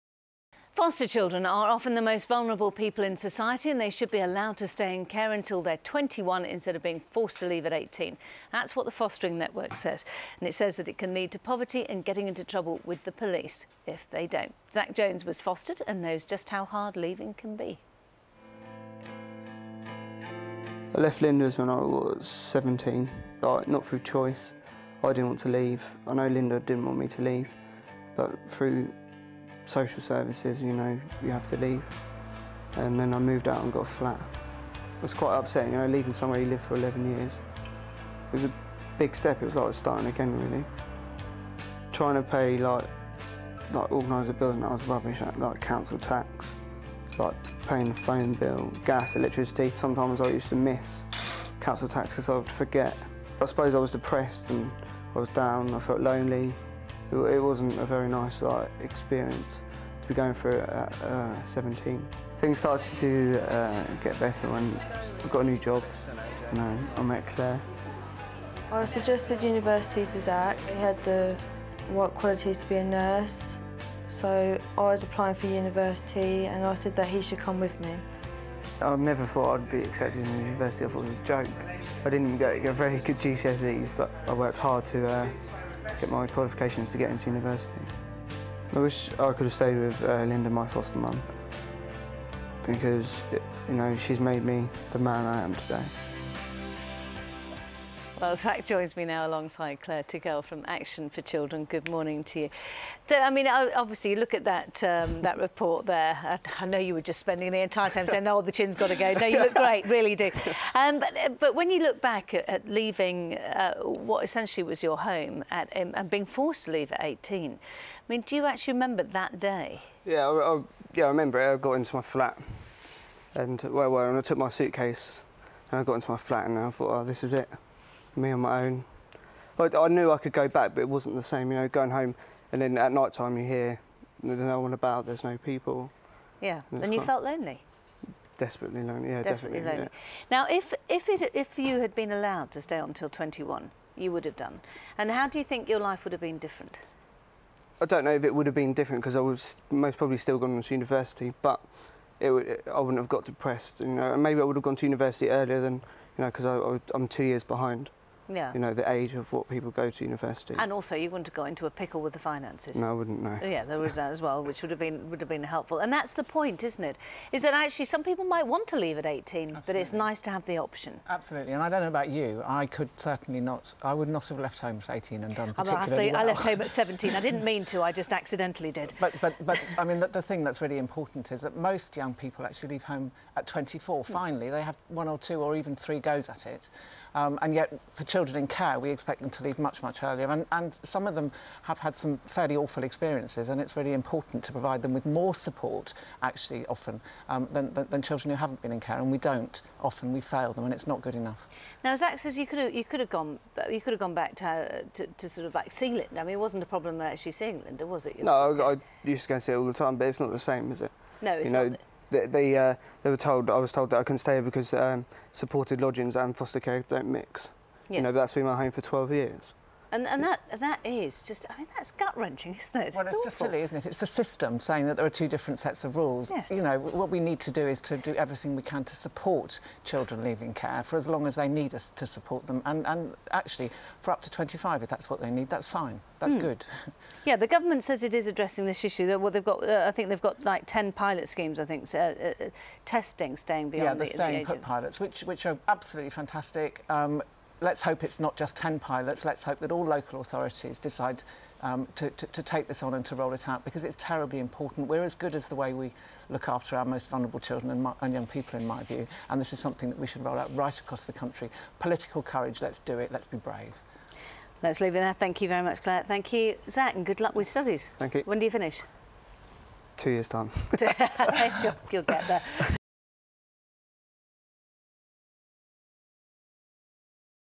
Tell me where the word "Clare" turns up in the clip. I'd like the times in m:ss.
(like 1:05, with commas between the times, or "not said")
1:39, 4:25.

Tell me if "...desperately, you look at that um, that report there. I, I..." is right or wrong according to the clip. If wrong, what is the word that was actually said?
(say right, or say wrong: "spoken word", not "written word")
wrong: "obviously", not "desperately".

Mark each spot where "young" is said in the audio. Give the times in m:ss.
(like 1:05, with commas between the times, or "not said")
3:01, 4:18.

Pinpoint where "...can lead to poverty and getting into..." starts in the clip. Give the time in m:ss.
0:10.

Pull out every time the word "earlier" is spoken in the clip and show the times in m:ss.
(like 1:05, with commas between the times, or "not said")
2:35, 3:10.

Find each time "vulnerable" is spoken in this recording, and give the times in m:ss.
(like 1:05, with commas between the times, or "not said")
0:02, 4:17.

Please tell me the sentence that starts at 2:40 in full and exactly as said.
And also, you wouldn't have got into a pickle with the finances.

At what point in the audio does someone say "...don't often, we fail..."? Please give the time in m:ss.
3:19.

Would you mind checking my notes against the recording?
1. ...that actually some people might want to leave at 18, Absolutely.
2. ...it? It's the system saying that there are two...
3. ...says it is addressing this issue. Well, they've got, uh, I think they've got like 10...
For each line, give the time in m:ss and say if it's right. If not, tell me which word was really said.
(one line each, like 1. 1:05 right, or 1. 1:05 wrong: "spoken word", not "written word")
1. 2:47 right
2. 3:43 right
3. 3:57 right.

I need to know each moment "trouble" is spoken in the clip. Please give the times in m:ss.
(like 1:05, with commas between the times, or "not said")
0:12.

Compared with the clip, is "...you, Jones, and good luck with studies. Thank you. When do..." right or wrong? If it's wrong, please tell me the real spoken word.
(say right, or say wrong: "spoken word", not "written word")
wrong: "Zac", not "Jones".